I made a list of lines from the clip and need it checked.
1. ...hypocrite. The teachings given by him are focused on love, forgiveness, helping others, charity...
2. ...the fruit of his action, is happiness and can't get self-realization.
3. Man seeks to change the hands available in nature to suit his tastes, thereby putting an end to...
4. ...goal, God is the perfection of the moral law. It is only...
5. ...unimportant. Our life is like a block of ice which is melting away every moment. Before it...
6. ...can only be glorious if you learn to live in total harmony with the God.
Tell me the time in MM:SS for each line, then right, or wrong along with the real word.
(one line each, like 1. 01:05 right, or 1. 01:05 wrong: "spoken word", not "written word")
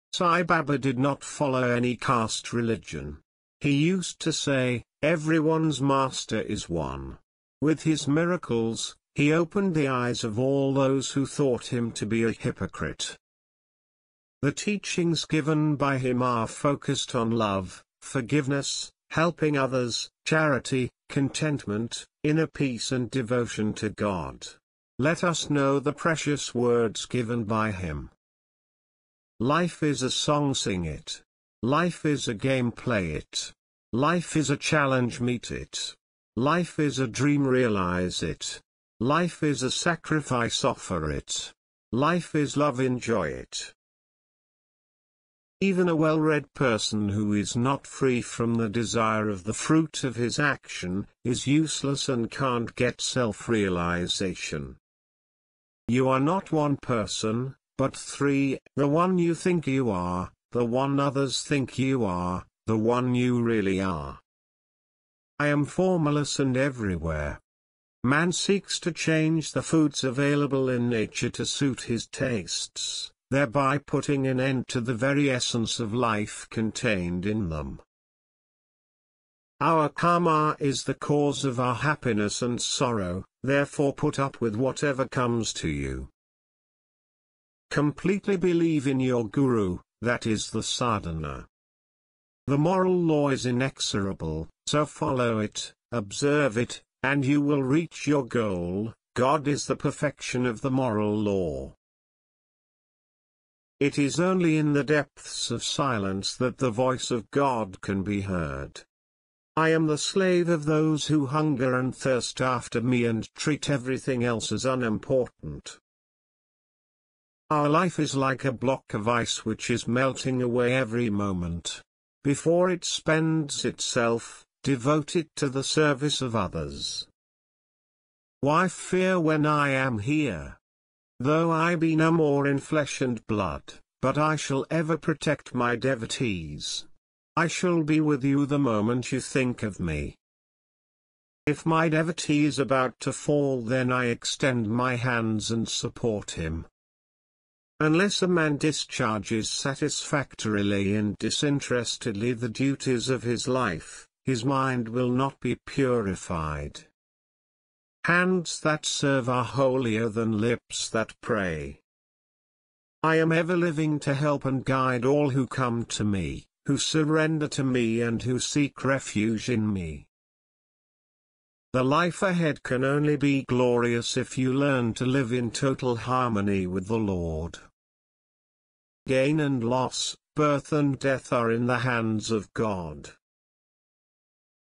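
1. 00:12 right
2. 00:49 wrong: "useless", not "happiness"
3. 01:08 wrong: "foods", not "hands"
4. 01:38 right
5. 01:54 right
6. 02:52 wrong: "Lord", not "God".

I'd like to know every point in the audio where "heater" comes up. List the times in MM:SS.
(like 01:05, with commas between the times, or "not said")
not said.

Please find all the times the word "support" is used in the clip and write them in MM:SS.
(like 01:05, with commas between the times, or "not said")
02:25.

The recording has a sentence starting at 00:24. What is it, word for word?
Let us know the precious words given by him.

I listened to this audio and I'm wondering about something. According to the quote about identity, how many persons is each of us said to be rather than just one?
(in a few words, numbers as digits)
3.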